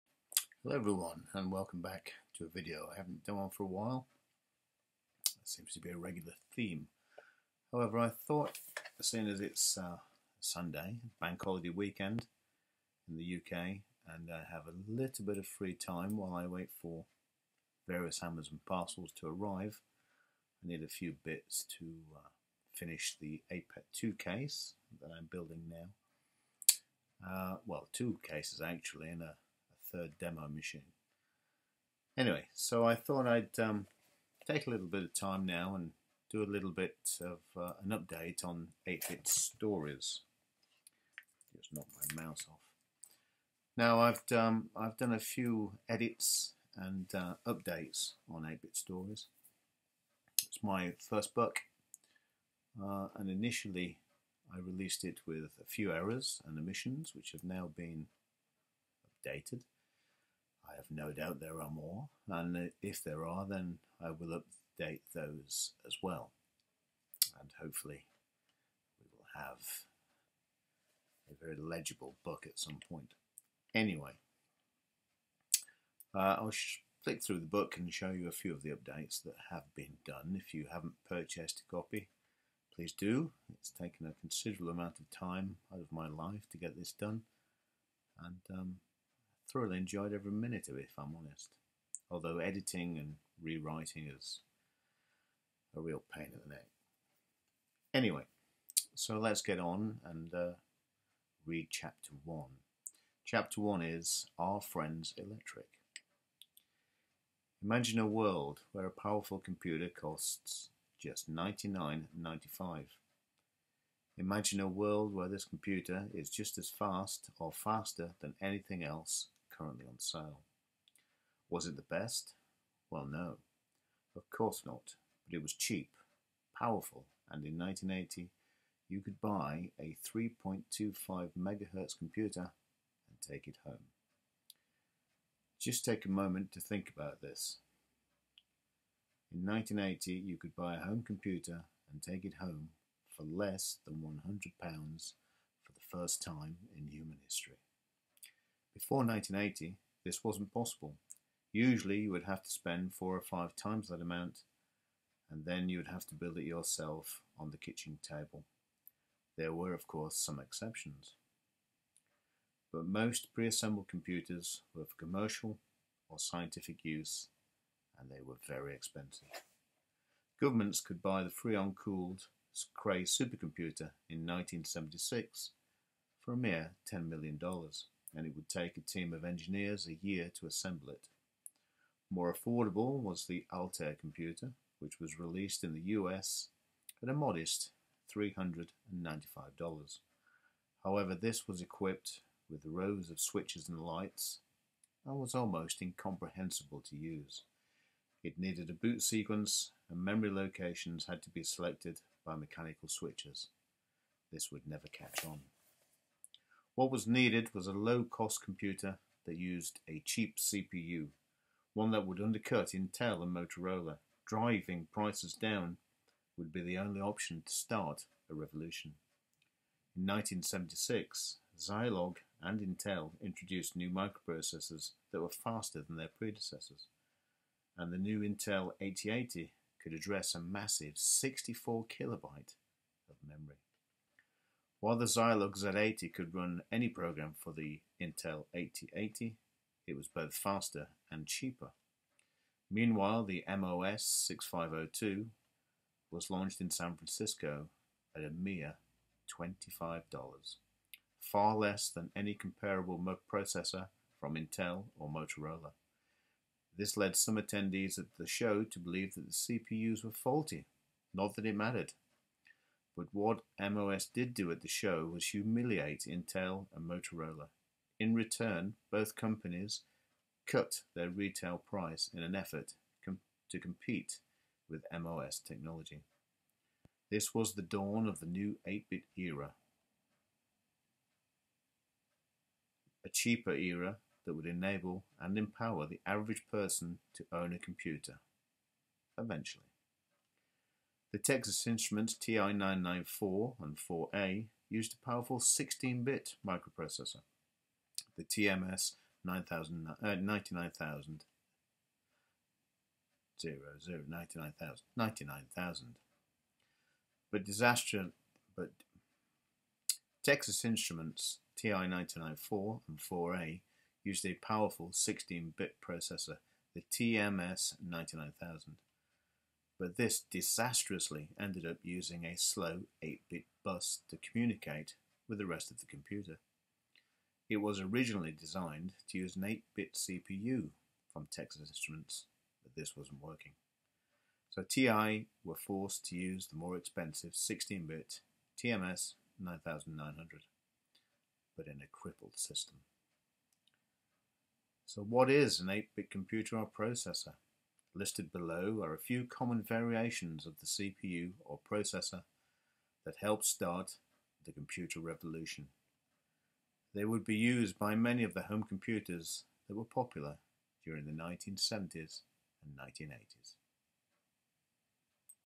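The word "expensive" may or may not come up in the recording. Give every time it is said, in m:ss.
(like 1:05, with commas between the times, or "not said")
2:48, 5:36.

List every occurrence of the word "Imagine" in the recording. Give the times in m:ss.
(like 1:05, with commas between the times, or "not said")
1:47, 1:54.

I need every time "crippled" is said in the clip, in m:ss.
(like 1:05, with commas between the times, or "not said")
5:41.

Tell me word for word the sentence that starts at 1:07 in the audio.
And hopefully, we will have a very legible book at some point.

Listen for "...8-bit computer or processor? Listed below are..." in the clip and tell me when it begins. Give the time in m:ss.
5:45.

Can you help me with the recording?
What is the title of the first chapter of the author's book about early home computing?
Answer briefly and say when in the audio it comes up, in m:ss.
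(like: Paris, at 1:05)
Our Friends Electric, at 1:44.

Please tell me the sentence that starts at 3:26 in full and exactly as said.
What was needed was a low-cost computer that used a cheap CPU, one that would undercut Intel and Motorola.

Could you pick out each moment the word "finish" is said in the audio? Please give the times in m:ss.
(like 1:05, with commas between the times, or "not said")
0:22.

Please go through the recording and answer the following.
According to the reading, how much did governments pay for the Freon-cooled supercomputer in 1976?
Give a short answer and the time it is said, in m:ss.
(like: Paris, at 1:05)
$10 million, at 2:56.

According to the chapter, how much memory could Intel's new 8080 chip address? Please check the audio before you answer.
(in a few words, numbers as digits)
64 kilobyte.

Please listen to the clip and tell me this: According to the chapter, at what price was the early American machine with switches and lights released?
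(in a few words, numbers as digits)
$395.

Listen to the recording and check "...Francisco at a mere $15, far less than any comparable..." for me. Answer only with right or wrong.
wrong.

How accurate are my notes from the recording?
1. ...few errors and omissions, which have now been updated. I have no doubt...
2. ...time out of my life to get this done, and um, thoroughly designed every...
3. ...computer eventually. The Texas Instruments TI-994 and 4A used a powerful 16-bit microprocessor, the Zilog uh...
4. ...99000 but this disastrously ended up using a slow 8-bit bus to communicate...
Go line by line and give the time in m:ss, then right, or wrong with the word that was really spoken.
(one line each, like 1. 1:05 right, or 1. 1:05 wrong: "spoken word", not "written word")
1. 0:55 right
2. 1:25 wrong: "enjoyed", not "designed"
3. 4:47 wrong: "TMS", not "Zilog"
4. 5:17 right.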